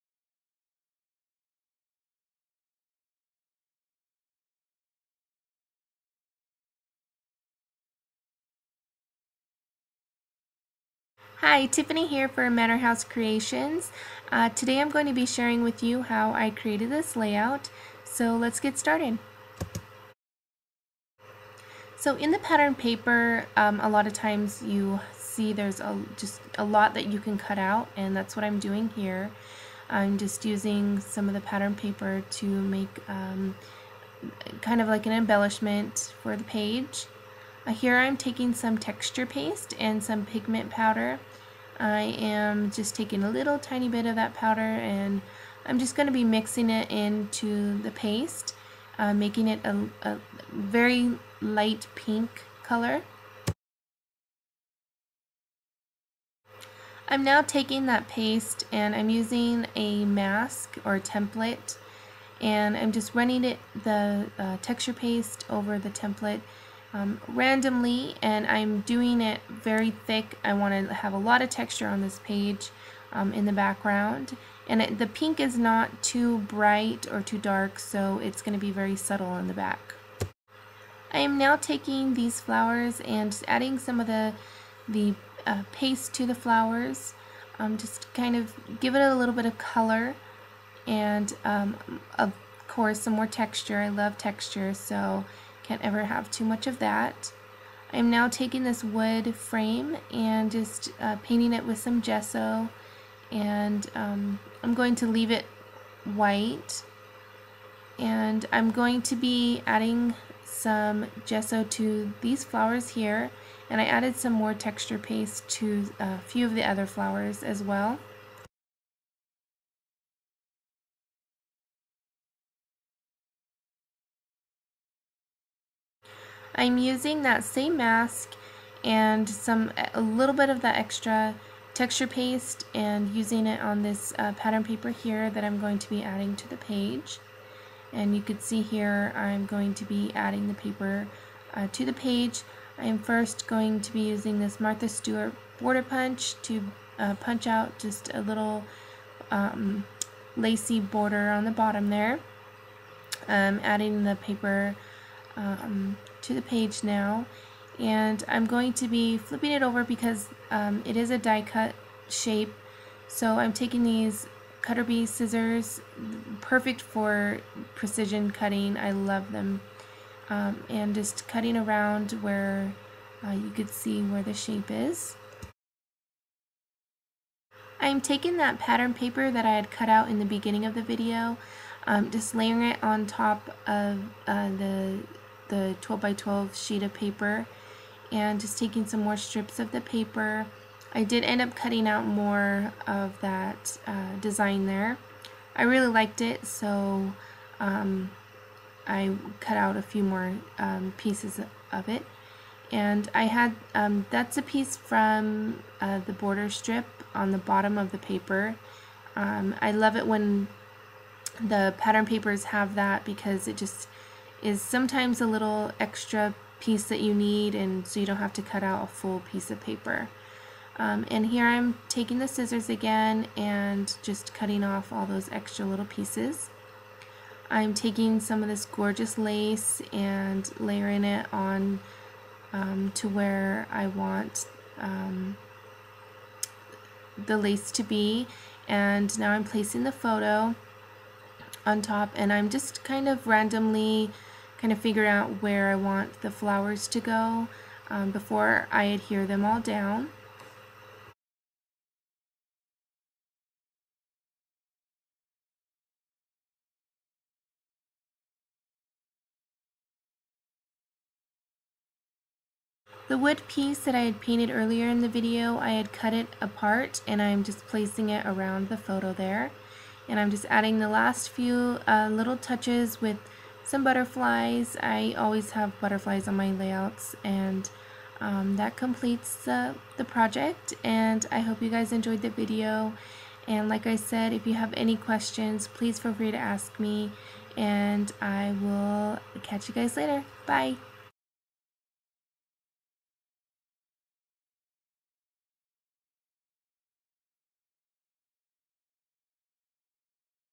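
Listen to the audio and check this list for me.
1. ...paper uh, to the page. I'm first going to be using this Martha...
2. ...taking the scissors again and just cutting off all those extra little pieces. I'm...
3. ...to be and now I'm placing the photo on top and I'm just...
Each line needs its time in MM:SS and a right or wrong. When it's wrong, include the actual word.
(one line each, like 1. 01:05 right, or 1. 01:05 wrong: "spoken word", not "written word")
1. 02:20 right
2. 03:41 right
3. 03:57 right.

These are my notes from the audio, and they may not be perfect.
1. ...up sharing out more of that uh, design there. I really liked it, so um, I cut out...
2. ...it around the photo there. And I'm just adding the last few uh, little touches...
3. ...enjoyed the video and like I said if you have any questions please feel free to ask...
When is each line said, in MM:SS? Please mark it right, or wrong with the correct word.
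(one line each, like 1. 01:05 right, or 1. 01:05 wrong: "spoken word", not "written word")
1. 03:11 wrong: "cutting", not "sharing"
2. 04:28 right
3. 04:41 right.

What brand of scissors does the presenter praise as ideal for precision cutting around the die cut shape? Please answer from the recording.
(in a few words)
cutter bee.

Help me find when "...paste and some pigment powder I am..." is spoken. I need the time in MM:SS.
00:39.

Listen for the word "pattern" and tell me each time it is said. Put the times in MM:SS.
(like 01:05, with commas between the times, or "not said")
00:22, 00:31, 02:14, 02:58, 03:31.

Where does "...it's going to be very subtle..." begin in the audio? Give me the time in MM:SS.
01:18.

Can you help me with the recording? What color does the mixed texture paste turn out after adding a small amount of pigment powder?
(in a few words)
light pink.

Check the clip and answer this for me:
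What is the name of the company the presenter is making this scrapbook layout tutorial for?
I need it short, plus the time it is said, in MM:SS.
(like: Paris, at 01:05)
Manor House Creations, at 00:12.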